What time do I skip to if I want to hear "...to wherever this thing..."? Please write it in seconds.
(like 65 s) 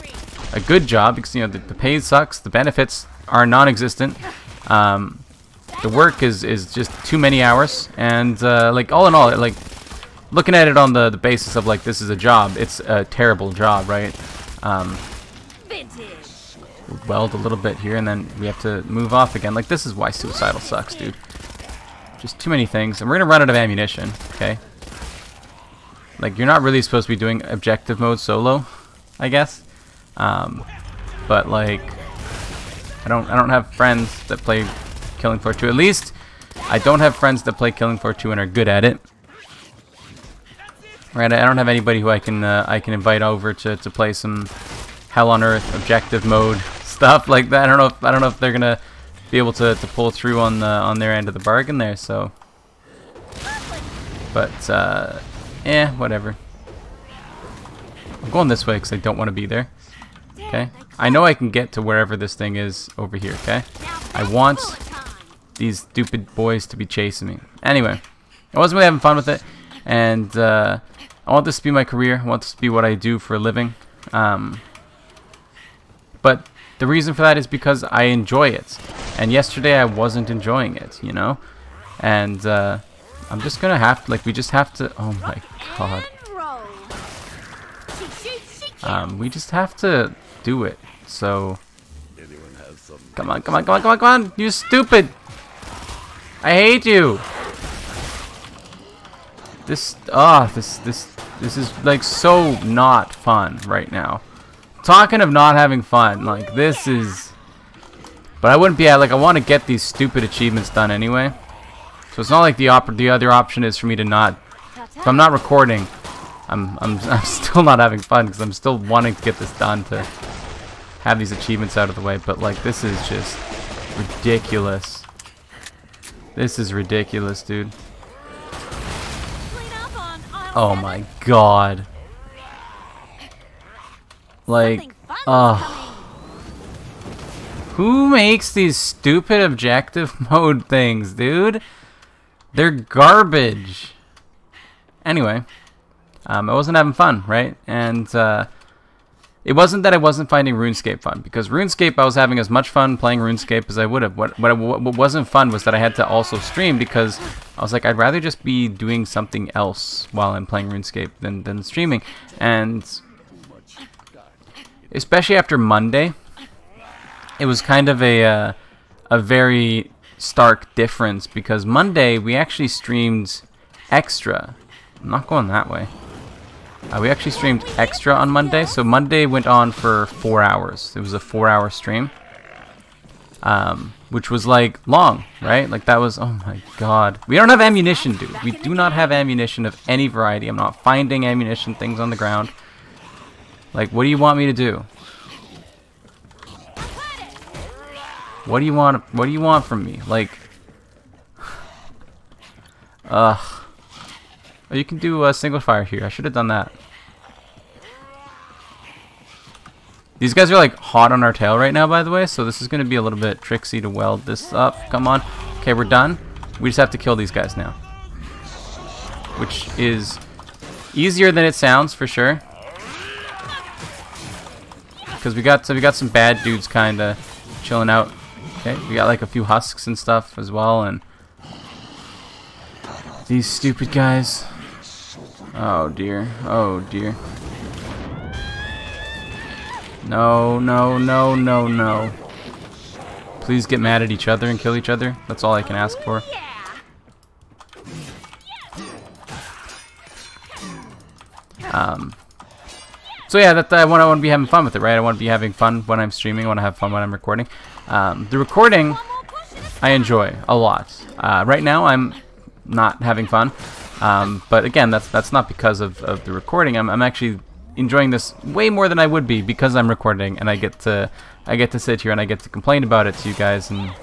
61 s.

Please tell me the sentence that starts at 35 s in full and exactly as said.
At least, I don't have friends that play Killing Floor 2 and are good at it.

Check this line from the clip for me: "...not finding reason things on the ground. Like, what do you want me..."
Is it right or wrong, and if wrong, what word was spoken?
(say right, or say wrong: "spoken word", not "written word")
wrong: "ammunition", not "reason".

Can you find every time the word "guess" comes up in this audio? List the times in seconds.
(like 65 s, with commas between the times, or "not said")
29 s.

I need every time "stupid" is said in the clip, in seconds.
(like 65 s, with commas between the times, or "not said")
65 s, 94 s, 109 s, 138 s, 233 s.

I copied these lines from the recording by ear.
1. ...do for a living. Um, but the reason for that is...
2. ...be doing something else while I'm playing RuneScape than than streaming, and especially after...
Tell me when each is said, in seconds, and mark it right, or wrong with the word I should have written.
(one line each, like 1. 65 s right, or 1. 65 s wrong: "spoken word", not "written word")
1. 72 s right
2. 158 s right.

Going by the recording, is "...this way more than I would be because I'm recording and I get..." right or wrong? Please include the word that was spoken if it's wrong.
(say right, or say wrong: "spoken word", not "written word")
right.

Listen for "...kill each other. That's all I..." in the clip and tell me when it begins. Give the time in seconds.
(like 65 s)
244 s.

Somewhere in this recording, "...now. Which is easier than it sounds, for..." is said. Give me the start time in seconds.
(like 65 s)
217 s.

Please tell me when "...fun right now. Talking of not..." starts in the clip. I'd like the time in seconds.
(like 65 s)
103 s.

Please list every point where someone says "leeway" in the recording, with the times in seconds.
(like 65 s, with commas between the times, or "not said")
not said.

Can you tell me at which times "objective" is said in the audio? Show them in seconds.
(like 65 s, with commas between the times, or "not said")
27 s, 45 s, 139 s.